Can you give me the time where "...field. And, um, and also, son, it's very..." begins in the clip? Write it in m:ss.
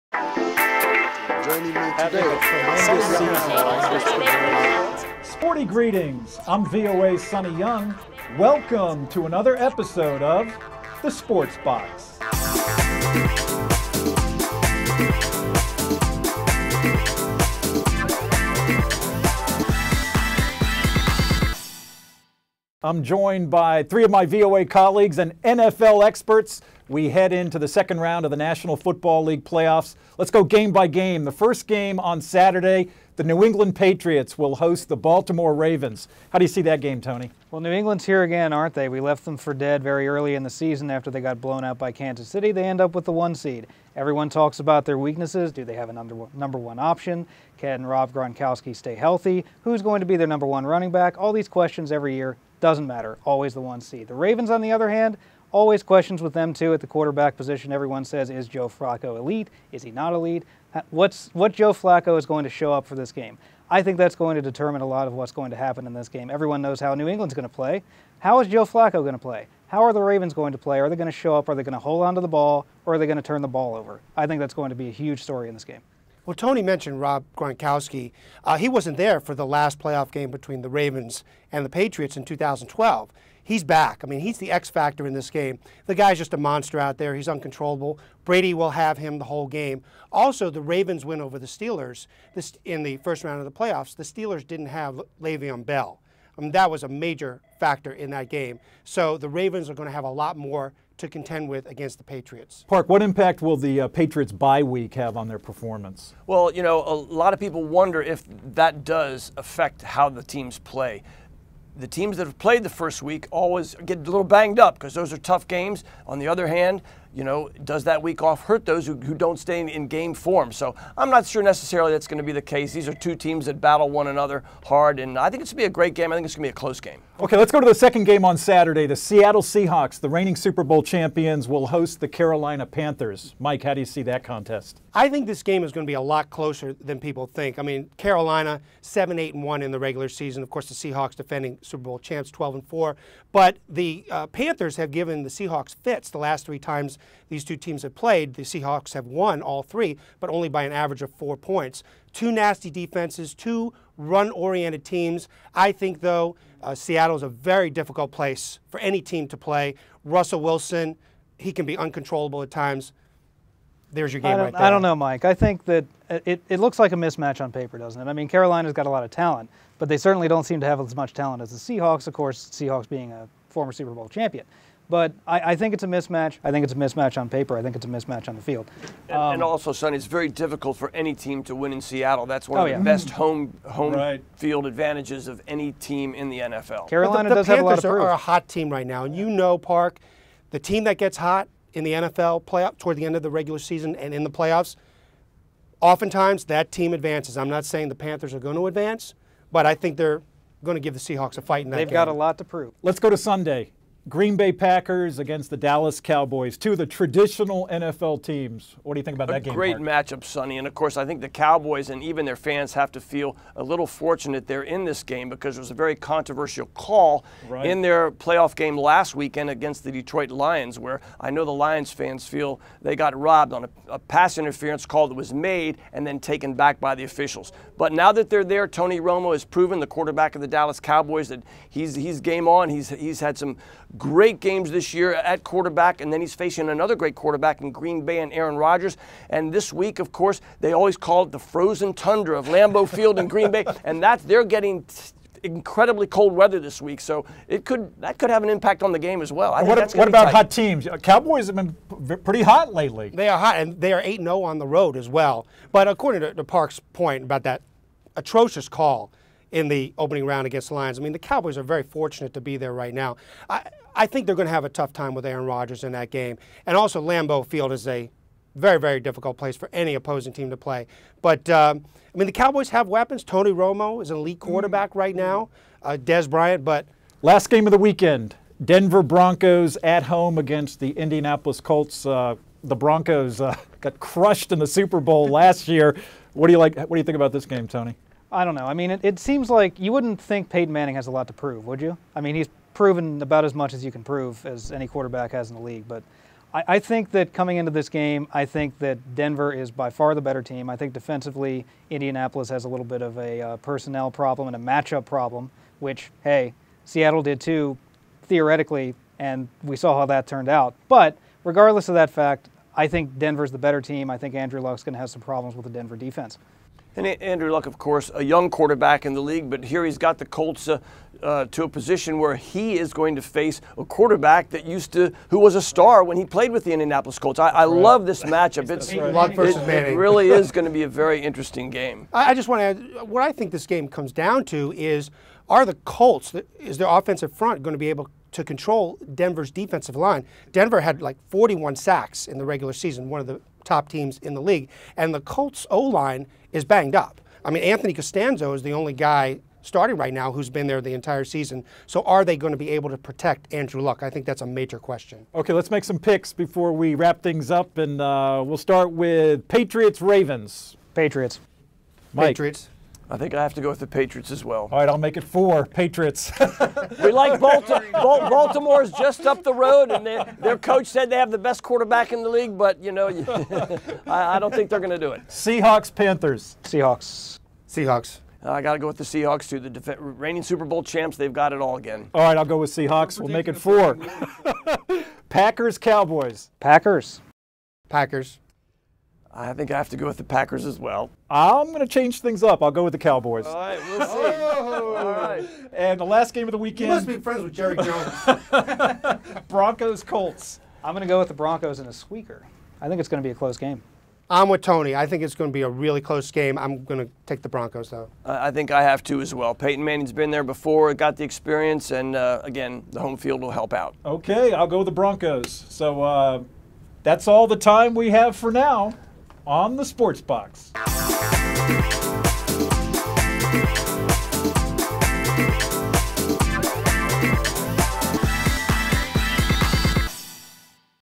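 2:58.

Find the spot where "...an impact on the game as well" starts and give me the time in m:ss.
4:08.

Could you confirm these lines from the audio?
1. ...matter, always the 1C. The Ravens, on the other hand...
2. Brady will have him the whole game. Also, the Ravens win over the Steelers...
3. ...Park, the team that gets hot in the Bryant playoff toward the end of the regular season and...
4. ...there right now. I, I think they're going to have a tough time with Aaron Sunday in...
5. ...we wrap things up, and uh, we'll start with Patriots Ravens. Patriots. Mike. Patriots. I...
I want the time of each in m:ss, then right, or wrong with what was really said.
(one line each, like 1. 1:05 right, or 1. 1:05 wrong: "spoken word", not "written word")
1. 0:52 right
2. 1:28 right
3. 3:09 wrong: "NFL", not "Bryant"
4. 4:22 wrong: "Rodgers", not "Sunday"
5. 5:56 right.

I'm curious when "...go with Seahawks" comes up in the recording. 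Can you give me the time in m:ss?
6:22.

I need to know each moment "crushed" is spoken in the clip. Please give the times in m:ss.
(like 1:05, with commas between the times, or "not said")
4:43.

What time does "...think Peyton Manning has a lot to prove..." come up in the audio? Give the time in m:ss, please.
4:50.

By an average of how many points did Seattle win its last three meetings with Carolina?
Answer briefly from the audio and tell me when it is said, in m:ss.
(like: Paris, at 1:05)
4, at 2:31.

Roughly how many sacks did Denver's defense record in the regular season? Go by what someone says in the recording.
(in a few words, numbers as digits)
41.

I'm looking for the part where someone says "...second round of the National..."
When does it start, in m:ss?
0:27.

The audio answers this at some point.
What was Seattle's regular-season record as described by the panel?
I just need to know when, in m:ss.
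2:22.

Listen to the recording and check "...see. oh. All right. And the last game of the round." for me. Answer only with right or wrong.
wrong.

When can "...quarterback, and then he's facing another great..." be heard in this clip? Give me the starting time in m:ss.
3:55.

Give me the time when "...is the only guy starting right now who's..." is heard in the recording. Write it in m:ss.
5:48.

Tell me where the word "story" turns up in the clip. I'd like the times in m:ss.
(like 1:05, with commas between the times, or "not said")
1:15.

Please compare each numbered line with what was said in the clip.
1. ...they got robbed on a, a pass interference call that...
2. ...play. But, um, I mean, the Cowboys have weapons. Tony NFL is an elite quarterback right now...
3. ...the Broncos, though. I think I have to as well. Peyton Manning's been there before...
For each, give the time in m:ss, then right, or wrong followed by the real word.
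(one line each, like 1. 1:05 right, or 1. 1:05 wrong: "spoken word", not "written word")
1. 3:42 right
2. 4:30 wrong: "Romo", not "NFL"
3. 6:47 right.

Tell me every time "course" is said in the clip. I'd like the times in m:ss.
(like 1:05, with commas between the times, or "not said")
2:20, 2:52, 3:30, 4:00, 5:17.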